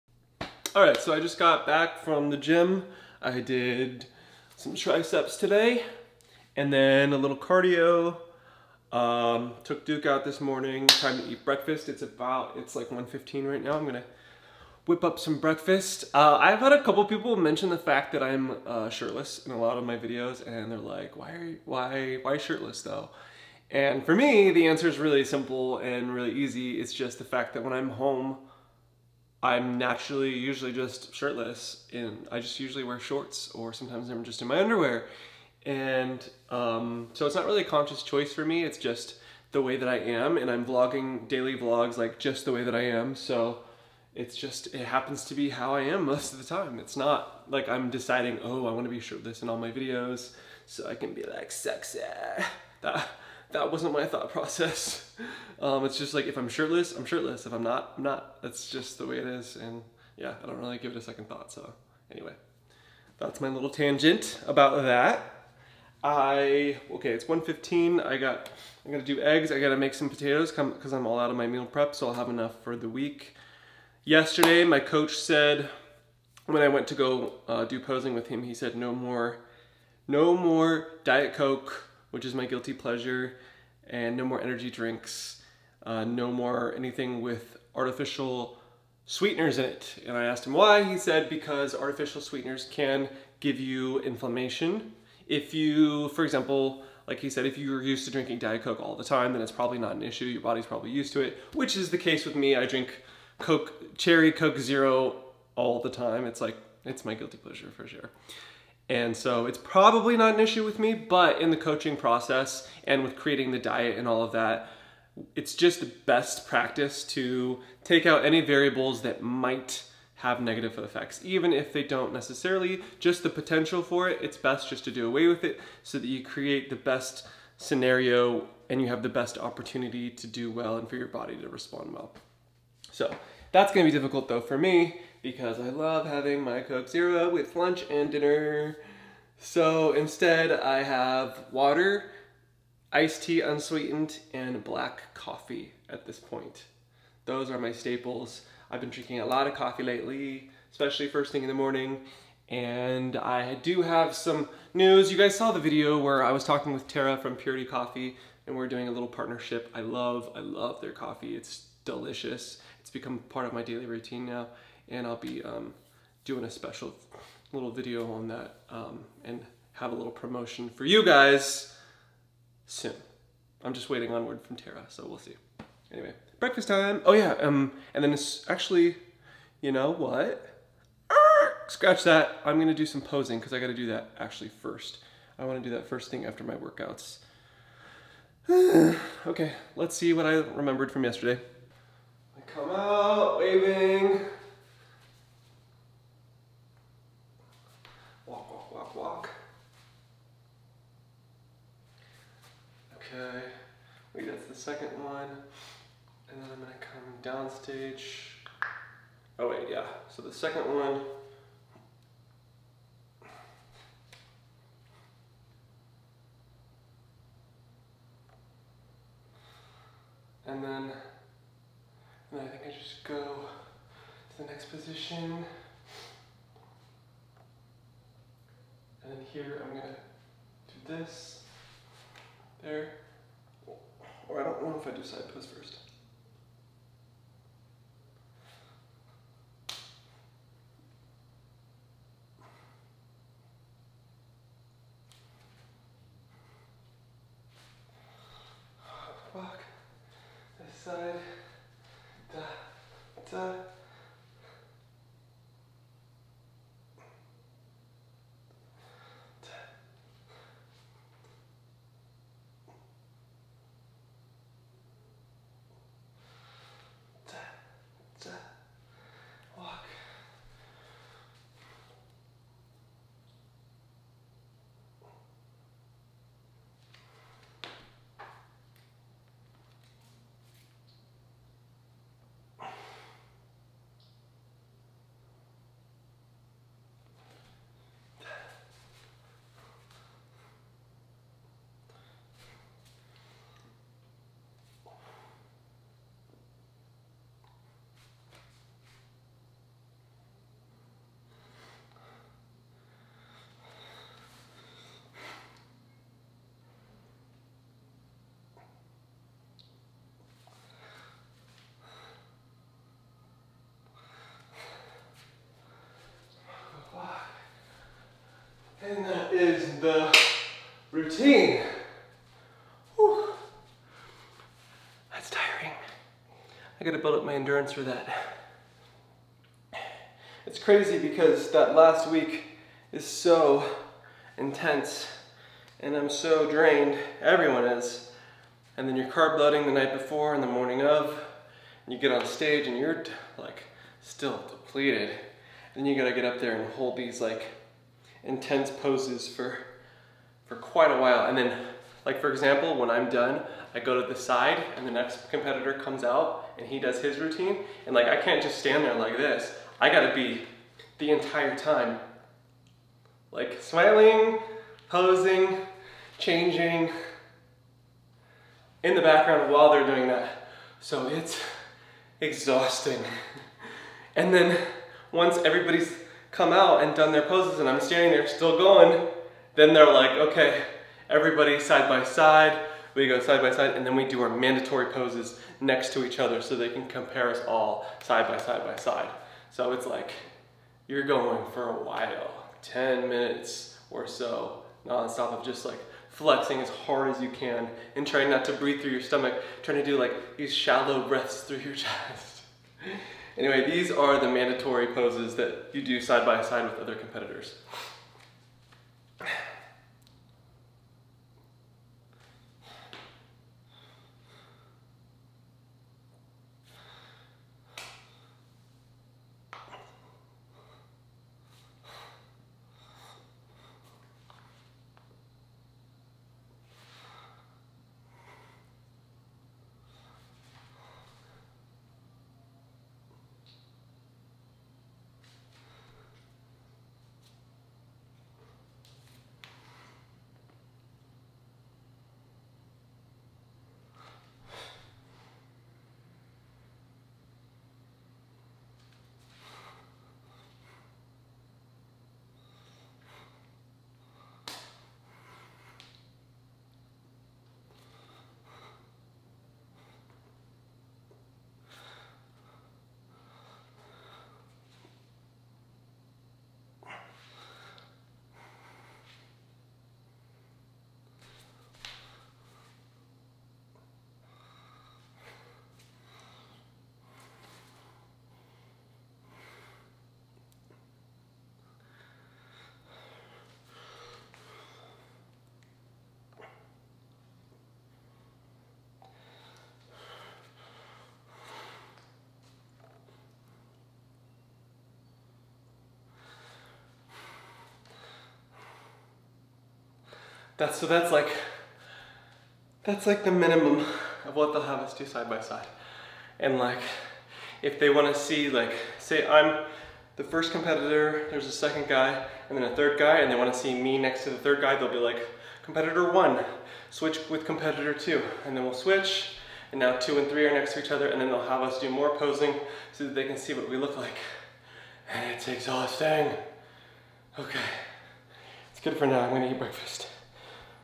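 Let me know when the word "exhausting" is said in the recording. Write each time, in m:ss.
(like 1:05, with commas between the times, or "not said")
6:12, 8:45.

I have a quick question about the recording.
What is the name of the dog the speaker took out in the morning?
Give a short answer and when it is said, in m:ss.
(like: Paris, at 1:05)
Duke, at 0:09.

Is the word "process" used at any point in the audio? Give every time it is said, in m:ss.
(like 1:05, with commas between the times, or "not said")
0:54, 1:51.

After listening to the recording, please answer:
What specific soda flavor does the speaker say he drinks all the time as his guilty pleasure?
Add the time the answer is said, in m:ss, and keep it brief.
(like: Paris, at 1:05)
Cherry Coke Zero, at 1:43.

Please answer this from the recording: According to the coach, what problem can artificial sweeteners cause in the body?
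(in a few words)
Inflammation.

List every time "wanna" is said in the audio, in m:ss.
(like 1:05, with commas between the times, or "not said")
0:48, 3:05, 8:27, 8:33.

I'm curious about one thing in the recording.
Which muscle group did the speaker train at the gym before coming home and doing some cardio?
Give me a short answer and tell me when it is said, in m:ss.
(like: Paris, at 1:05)
Triceps, at 0:04.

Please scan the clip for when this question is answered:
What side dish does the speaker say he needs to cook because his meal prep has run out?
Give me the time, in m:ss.
1:10.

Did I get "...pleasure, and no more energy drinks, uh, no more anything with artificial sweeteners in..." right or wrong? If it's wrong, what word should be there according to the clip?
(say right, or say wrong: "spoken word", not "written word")
right.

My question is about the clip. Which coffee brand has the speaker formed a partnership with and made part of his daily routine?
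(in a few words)
Purity Coffee.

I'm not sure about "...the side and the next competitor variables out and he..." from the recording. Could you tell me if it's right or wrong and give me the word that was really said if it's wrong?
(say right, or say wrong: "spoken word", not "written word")
wrong: "comes", not "variables".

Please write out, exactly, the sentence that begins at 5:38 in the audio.
And then you're carb loading the night before and the morning of, and you get on stage and you're like still depleted.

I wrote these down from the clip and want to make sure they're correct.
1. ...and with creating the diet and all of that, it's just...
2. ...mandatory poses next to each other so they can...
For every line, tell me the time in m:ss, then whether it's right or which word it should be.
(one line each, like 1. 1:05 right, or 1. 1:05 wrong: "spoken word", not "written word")
1. 1:52 right
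2. 6:24 right.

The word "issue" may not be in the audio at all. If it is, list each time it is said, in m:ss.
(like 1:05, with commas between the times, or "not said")
1:40, 1:50.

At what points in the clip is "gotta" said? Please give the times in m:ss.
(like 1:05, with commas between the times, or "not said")
1:09, 3:03, 5:26, 5:45, 5:59.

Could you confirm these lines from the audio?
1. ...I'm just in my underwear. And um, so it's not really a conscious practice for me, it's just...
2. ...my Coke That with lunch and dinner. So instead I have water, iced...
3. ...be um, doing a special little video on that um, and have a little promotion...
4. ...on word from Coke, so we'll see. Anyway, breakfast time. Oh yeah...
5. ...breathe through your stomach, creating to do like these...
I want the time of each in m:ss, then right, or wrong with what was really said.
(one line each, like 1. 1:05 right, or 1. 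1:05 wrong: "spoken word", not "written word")
1. 0:34 wrong: "choice", not "practice"
2. 2:16 wrong: "Zero", not "That"
3. 2:45 right
4. 2:54 wrong: "Tara", not "Coke"
5. 6:38 wrong: "trying", not "creating".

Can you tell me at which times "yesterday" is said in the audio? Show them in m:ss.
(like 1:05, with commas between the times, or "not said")
1:14, 3:11.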